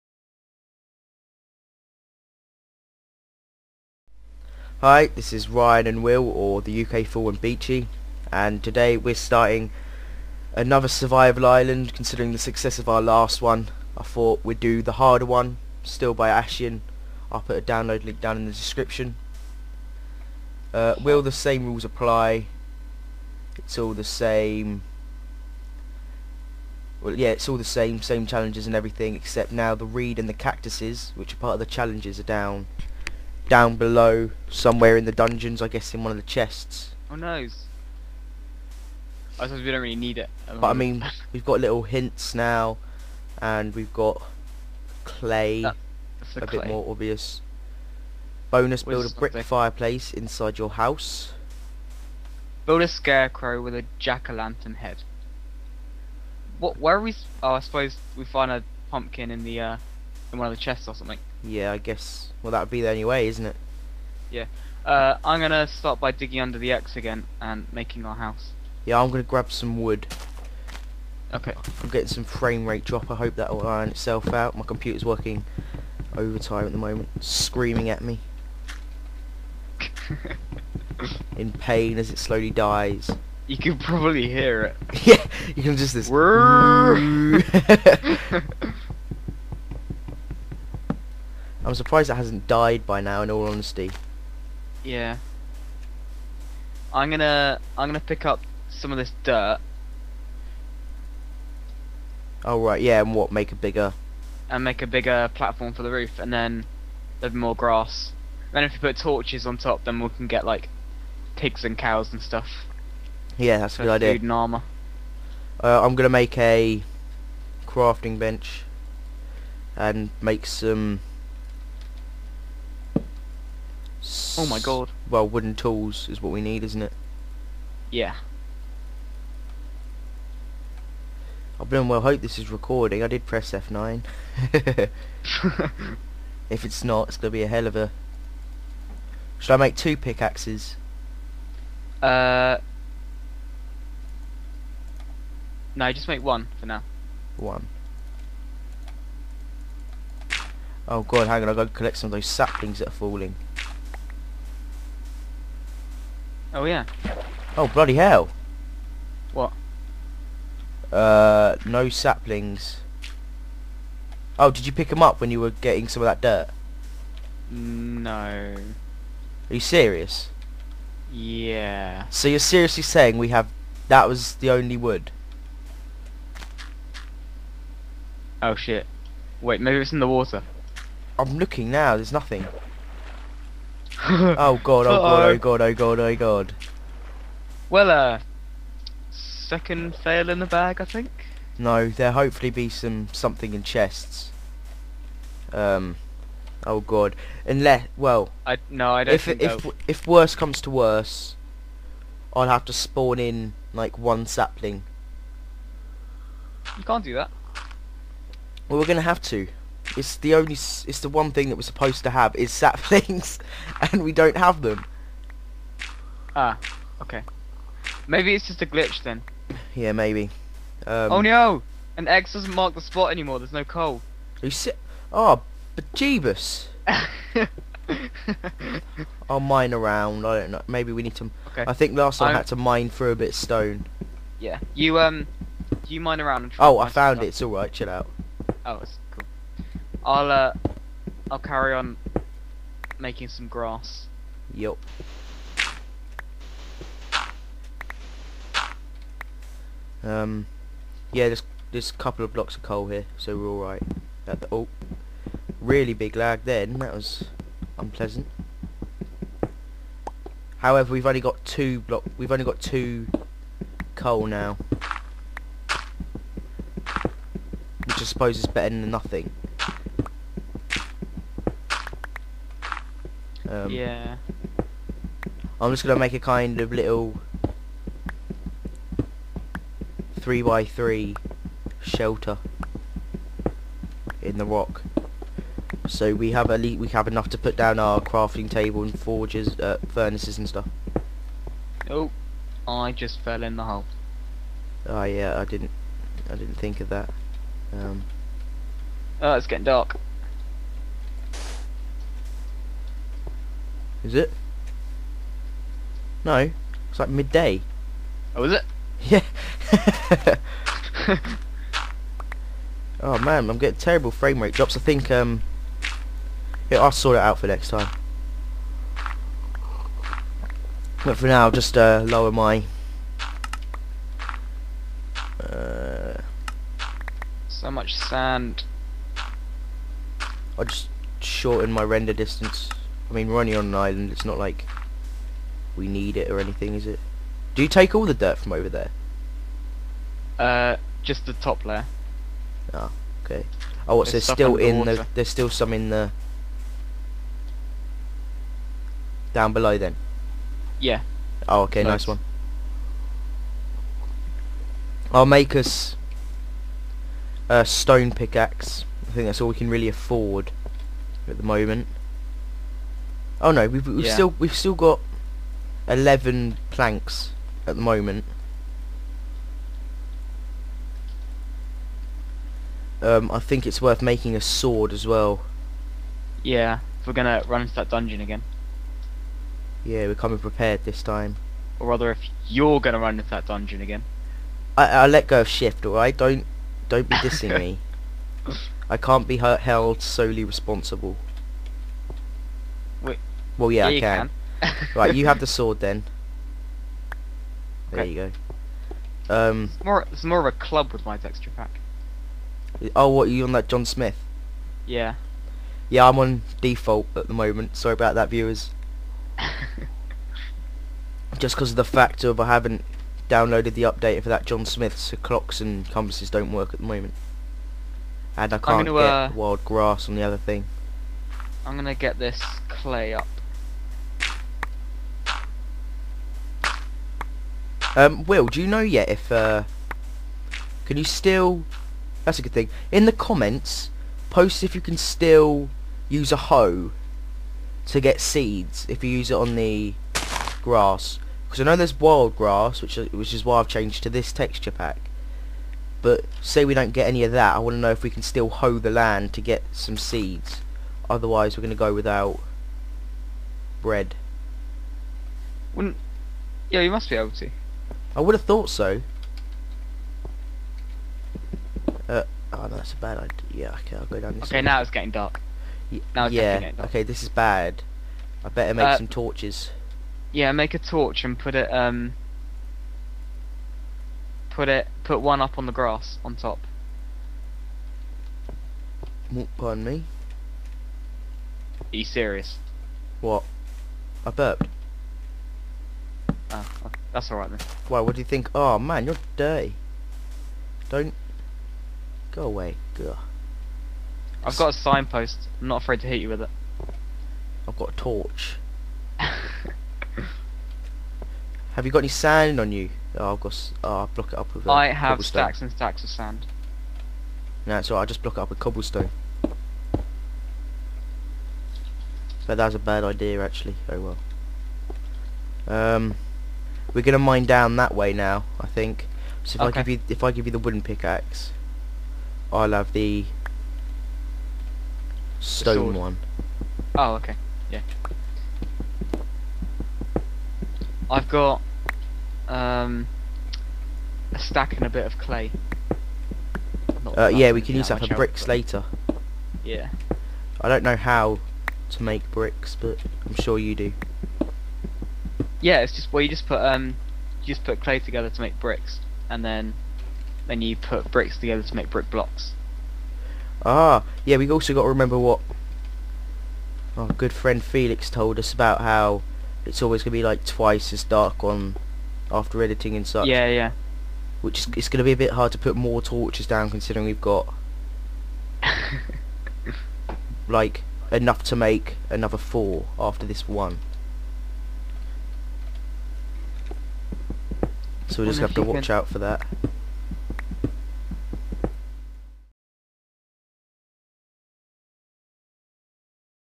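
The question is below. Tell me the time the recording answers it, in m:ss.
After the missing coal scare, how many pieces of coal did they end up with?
4:22.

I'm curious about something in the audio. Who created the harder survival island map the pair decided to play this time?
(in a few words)
Ashian.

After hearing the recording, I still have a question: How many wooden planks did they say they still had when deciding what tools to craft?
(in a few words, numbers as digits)
11.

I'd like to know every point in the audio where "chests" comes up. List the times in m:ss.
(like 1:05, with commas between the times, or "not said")
0:36, 1:00, 3:13.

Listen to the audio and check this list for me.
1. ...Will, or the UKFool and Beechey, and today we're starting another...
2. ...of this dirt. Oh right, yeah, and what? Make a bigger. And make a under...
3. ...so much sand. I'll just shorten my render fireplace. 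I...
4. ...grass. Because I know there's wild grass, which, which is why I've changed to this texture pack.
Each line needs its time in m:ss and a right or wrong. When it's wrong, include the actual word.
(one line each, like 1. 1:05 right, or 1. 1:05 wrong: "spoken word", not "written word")
1. 0:06 right
2. 1:38 wrong: "bigger", not "under"
3. 5:27 wrong: "distance", not "fireplace"
4. 7:20 right.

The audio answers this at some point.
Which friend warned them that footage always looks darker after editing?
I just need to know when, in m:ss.
9:17.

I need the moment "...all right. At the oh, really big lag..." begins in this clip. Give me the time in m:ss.
4:13.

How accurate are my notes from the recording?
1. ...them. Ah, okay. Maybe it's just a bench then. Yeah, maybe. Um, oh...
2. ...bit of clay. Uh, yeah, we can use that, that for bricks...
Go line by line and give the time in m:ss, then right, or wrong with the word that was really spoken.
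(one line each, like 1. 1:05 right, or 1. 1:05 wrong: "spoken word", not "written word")
1. 3:34 wrong: "glitch", not "bench"
2. 8:54 right.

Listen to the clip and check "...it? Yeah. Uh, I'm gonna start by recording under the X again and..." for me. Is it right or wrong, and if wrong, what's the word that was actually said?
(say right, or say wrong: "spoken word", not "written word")
wrong: "digging", not "recording".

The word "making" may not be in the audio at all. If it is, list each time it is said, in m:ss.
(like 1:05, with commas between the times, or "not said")
1:07, 4:02, 6:14.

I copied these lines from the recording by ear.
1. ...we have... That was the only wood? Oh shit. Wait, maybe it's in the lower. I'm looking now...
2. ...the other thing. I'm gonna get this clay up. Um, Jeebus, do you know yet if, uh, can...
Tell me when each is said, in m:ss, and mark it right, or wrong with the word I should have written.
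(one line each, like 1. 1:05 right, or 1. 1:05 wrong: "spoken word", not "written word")
1. 2:53 wrong: "water", not "lower"
2. 7:00 wrong: "Will", not "Jeebus".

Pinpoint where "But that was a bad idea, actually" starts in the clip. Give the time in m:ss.
8:32.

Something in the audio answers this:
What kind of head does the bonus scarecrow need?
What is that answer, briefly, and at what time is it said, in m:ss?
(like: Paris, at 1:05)
jack-o'-lantern, at 0:53.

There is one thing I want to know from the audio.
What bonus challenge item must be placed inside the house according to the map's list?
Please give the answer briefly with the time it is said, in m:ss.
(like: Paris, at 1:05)
brick fireplace, at 0:49.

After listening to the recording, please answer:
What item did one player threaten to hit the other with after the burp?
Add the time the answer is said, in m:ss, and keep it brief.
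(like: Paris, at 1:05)
signpost, at 8:14.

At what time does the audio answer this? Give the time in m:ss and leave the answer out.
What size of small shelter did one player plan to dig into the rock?
4:40.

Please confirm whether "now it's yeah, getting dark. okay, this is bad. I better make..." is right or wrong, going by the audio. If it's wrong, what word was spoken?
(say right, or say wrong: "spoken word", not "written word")
right.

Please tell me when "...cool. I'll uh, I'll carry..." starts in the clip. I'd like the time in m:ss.
3:59.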